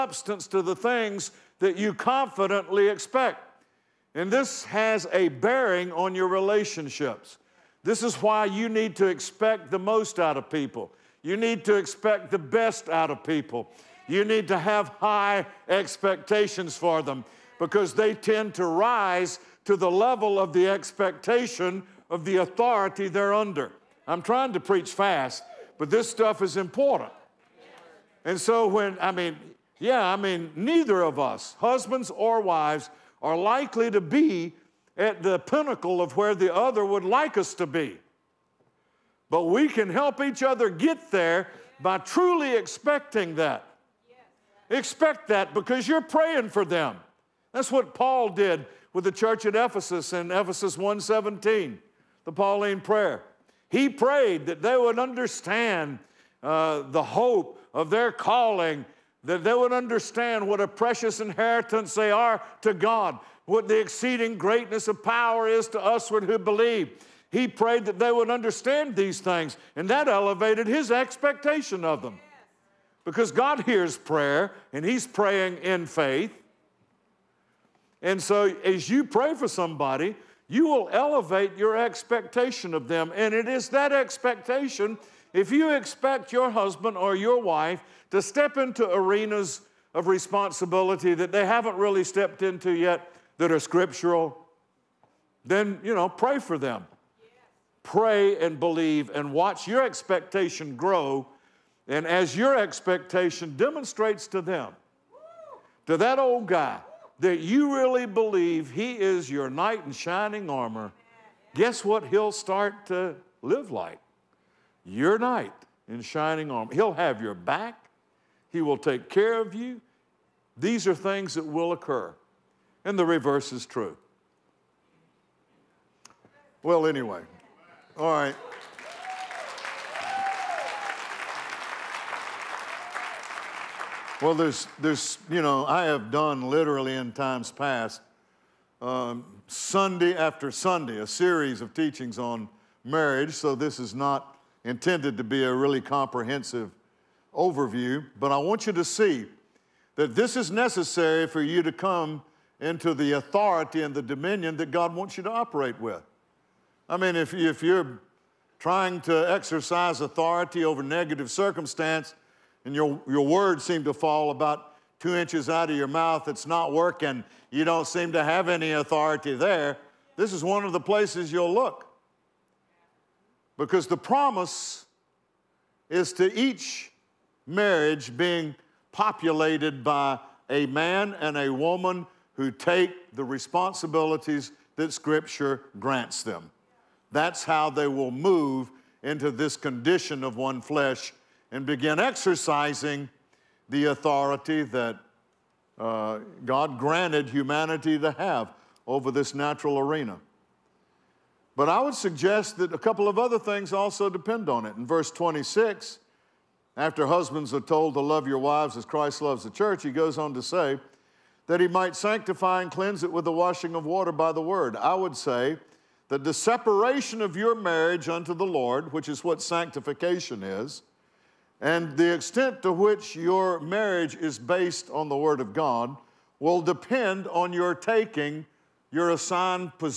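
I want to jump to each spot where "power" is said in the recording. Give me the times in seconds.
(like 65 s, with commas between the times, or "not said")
65 s.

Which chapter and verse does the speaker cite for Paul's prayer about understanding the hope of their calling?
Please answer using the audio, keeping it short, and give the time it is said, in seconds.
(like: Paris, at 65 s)
1:17, at 50 s.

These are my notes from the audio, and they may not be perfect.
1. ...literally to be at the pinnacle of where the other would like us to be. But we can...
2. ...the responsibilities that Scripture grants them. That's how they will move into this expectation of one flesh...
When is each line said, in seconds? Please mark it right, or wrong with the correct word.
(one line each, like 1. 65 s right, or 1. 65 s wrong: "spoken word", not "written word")
1. 33 s wrong: "likely", not "literally"
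2. 183 s wrong: "condition", not "expectation".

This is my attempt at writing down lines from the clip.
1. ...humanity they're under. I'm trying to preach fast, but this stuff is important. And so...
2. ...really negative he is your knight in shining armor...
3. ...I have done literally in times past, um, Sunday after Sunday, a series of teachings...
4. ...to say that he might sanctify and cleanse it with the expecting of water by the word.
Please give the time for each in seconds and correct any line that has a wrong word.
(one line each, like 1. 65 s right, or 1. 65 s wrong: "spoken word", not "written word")
1. 22 s wrong: "authority", not "humanity"
2. 107 s wrong: "believe", not "negative"
3. 135 s right
4. 210 s wrong: "washing", not "expecting".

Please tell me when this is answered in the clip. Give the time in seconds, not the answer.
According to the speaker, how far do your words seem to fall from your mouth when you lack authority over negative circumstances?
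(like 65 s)
164 s.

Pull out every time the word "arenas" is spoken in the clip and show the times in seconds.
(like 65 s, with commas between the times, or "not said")
88 s, 199 s.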